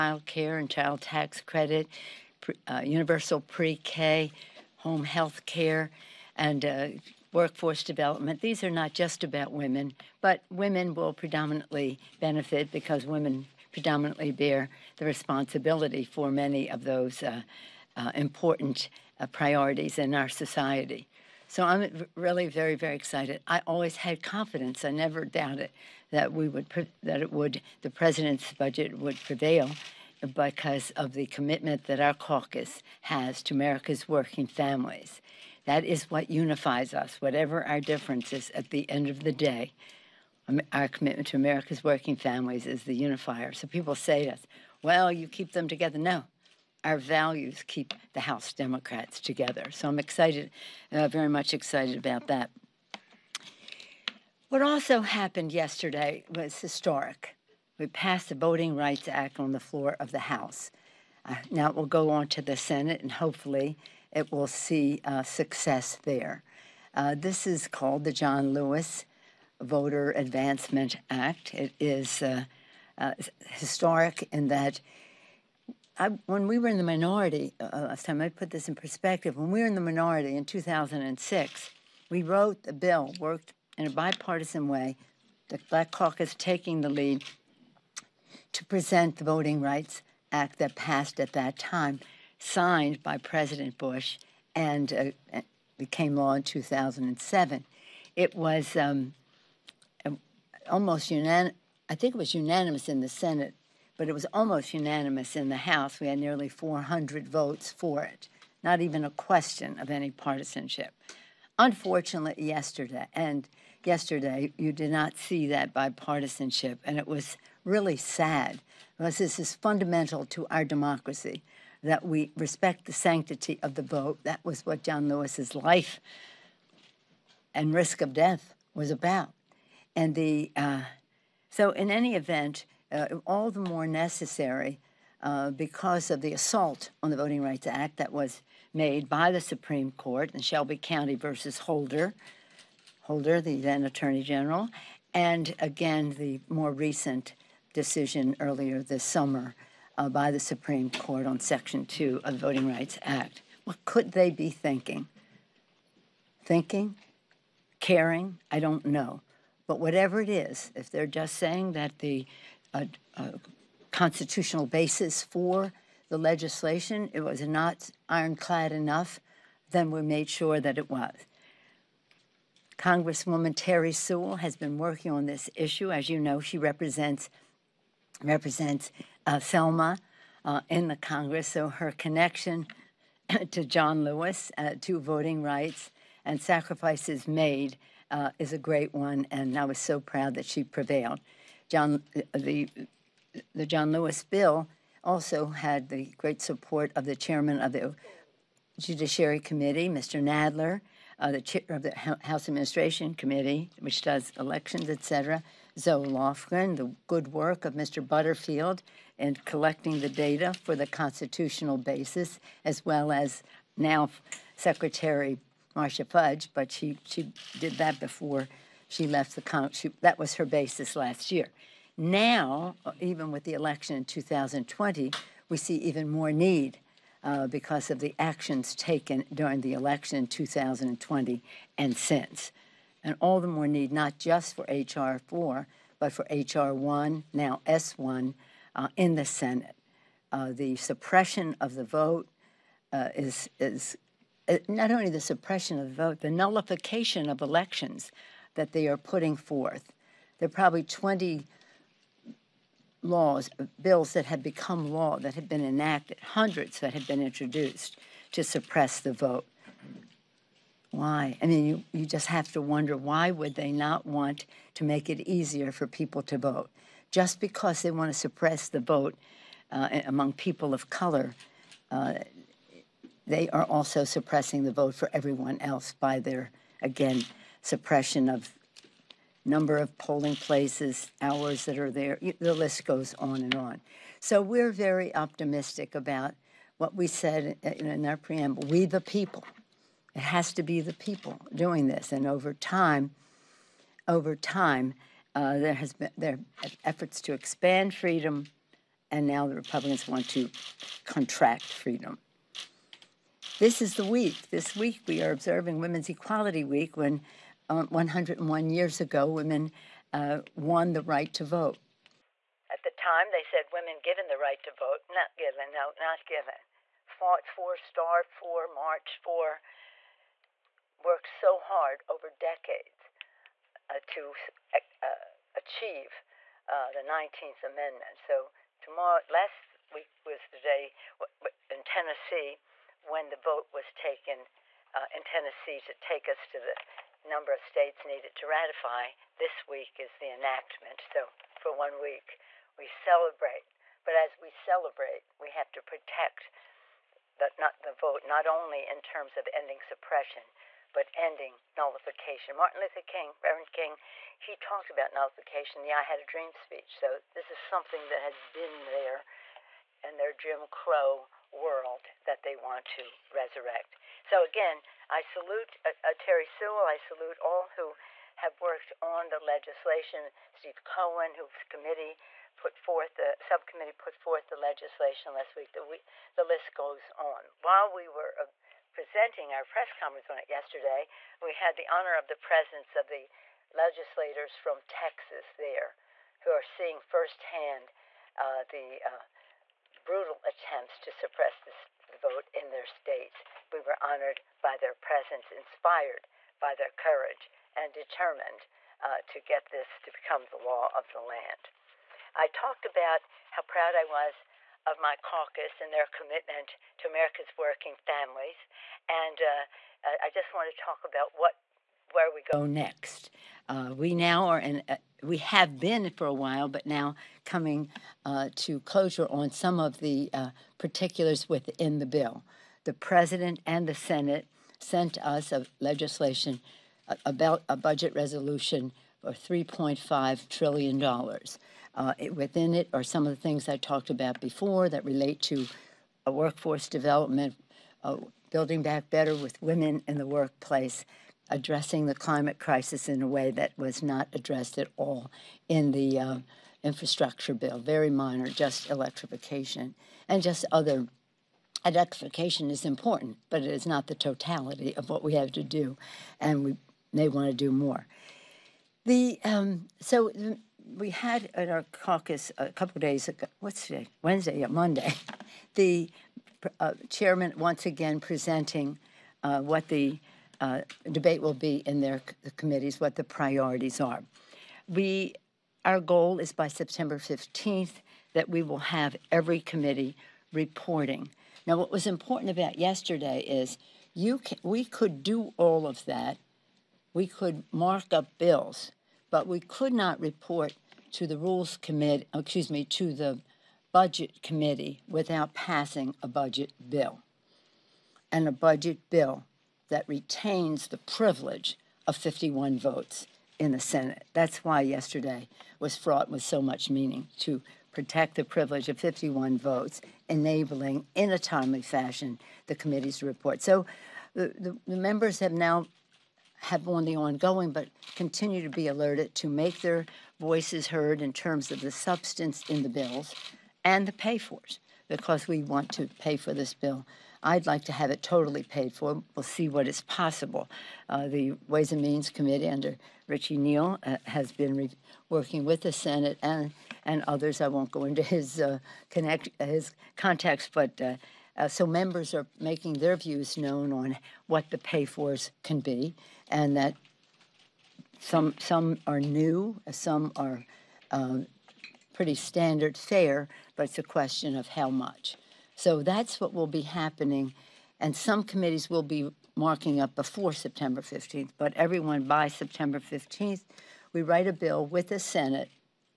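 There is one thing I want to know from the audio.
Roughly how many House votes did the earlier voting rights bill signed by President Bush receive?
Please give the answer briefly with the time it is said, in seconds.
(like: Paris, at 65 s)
nearly 400, at 106 s.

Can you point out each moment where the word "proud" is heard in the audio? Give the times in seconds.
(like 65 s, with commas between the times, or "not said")
189 s, 403 s.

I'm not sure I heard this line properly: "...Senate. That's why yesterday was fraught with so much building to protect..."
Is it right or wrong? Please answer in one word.
wrong.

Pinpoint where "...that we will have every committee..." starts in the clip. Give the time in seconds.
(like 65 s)
478 s.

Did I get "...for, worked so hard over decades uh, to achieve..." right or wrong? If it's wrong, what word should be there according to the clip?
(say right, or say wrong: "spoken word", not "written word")
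right.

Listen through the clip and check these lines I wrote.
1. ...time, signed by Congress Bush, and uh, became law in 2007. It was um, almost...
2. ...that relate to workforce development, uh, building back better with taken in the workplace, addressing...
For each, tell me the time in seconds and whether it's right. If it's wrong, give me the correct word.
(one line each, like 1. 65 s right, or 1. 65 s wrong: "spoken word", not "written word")
1. 91 s wrong: "President", not "Congress"
2. 434 s wrong: "women", not "taken".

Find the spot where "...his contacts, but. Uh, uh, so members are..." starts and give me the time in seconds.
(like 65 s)
539 s.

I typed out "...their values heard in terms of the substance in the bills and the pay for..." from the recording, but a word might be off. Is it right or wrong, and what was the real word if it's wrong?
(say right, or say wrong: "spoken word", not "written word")
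wrong: "voices", not "values".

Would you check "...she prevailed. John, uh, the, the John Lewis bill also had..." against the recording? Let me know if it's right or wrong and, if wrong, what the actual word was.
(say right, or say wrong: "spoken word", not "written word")
right.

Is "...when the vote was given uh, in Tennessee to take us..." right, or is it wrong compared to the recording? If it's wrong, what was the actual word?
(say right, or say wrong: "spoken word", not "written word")
wrong: "taken", not "given".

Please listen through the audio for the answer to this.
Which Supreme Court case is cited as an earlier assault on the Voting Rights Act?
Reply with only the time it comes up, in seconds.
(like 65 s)
140 s.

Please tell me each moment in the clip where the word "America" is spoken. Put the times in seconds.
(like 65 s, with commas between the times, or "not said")
33 s, 41 s, 407 s.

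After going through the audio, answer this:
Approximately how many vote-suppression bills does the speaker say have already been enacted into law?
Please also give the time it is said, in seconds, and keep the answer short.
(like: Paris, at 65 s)
20, at 250 s.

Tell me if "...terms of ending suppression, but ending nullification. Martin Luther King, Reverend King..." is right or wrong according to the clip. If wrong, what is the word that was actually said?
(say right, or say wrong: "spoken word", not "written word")
right.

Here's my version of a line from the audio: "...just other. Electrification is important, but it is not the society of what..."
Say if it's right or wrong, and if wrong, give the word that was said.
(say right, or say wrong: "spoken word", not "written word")
wrong: "totality", not "society".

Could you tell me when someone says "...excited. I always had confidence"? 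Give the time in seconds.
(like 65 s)
22 s.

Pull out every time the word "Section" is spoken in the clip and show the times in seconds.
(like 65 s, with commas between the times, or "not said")
151 s.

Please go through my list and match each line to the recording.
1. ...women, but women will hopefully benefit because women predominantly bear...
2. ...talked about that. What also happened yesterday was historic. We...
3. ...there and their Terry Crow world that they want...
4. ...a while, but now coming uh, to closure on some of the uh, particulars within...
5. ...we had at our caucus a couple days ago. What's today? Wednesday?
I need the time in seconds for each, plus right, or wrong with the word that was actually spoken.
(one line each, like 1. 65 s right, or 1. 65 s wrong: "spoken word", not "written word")
1. 9 s wrong: "predominantly", not "hopefully"
2. 51 s wrong: "excited", not "talked"
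3. 358 s wrong: "Jim", not "Terry"
4. 416 s right
5. 460 s right.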